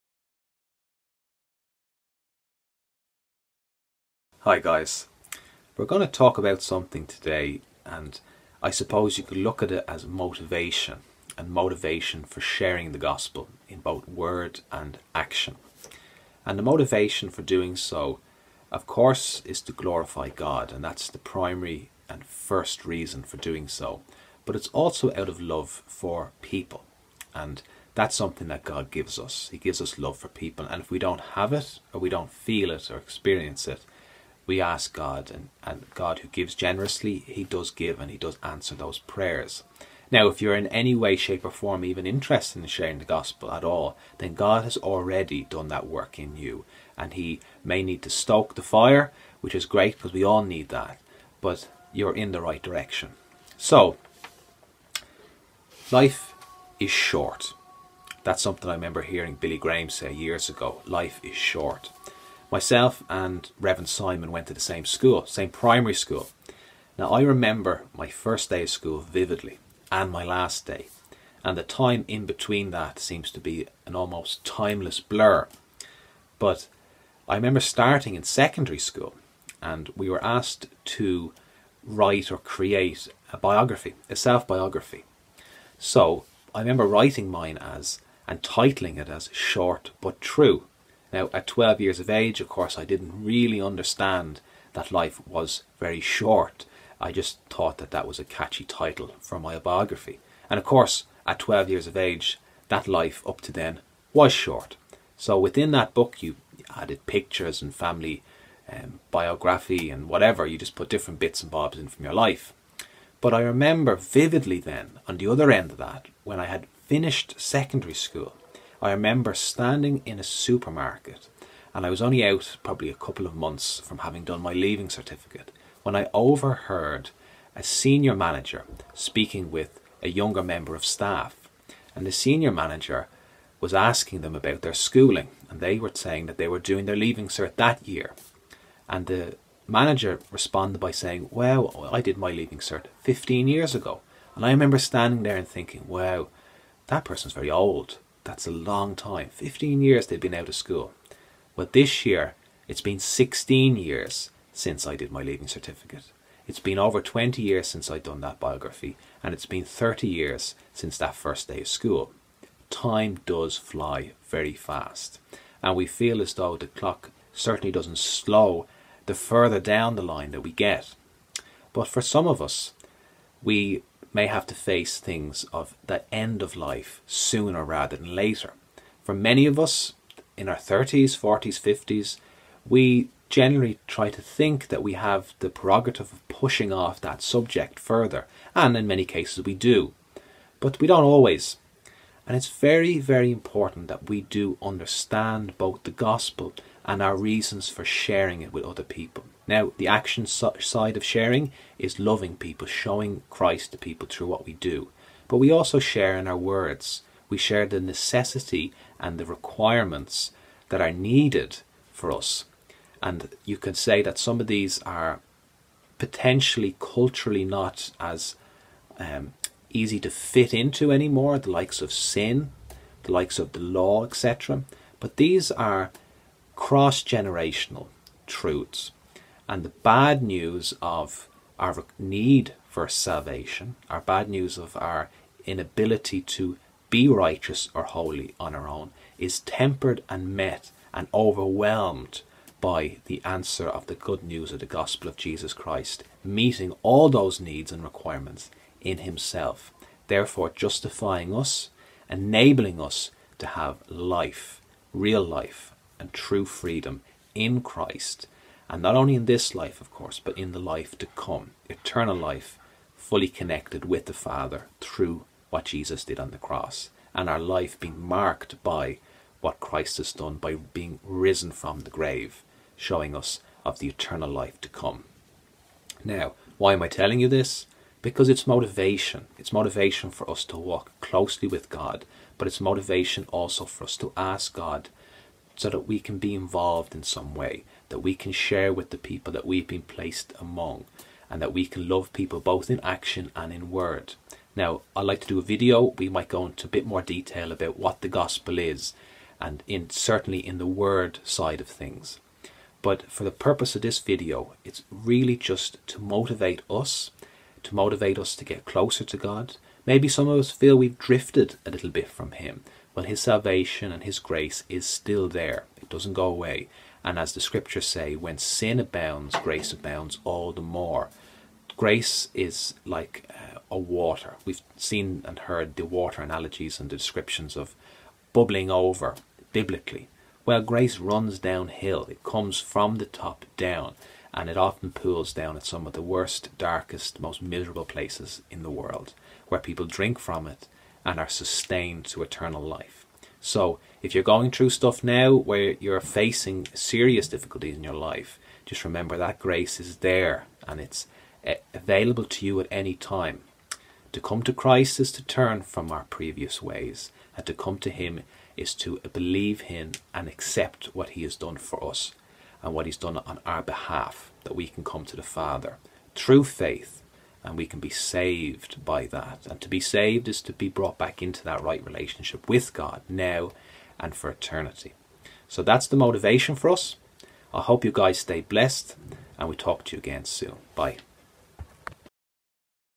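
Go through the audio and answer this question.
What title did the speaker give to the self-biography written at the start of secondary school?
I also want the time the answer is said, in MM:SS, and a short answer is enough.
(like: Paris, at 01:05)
Short But True, at 01:29.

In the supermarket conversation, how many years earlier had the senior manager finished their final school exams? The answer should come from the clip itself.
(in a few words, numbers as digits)
15.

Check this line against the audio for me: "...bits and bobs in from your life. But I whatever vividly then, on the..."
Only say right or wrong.
wrong.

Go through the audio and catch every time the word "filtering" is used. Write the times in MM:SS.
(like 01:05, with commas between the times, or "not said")
not said.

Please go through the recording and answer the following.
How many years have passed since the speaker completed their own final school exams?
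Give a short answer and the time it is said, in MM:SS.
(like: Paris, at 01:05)
16, at 02:32.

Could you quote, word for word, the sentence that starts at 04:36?
Now, why am I telling you this?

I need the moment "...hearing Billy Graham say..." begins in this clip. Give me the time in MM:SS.
00:59.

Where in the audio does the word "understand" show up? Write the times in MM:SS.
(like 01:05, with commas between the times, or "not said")
01:33, 03:14.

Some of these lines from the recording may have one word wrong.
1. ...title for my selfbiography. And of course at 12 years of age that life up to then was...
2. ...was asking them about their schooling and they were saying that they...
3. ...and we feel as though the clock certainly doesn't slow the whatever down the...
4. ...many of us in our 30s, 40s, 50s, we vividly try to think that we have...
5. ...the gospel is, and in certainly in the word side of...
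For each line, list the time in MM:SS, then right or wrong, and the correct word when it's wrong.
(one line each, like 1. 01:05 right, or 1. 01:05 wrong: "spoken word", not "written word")
1. 01:38 wrong: "biography", not "selfbiography"
2. 02:13 right
3. 02:45 wrong: "further", not "whatever"
4. 02:59 wrong: "generally", not "vividly"
5. 04:58 right.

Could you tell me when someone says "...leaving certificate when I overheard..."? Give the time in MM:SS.
02:04.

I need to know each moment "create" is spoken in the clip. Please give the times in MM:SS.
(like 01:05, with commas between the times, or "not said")
01:22.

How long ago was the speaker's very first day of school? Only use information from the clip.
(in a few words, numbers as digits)
30 years.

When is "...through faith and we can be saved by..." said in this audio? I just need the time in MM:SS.
06:06.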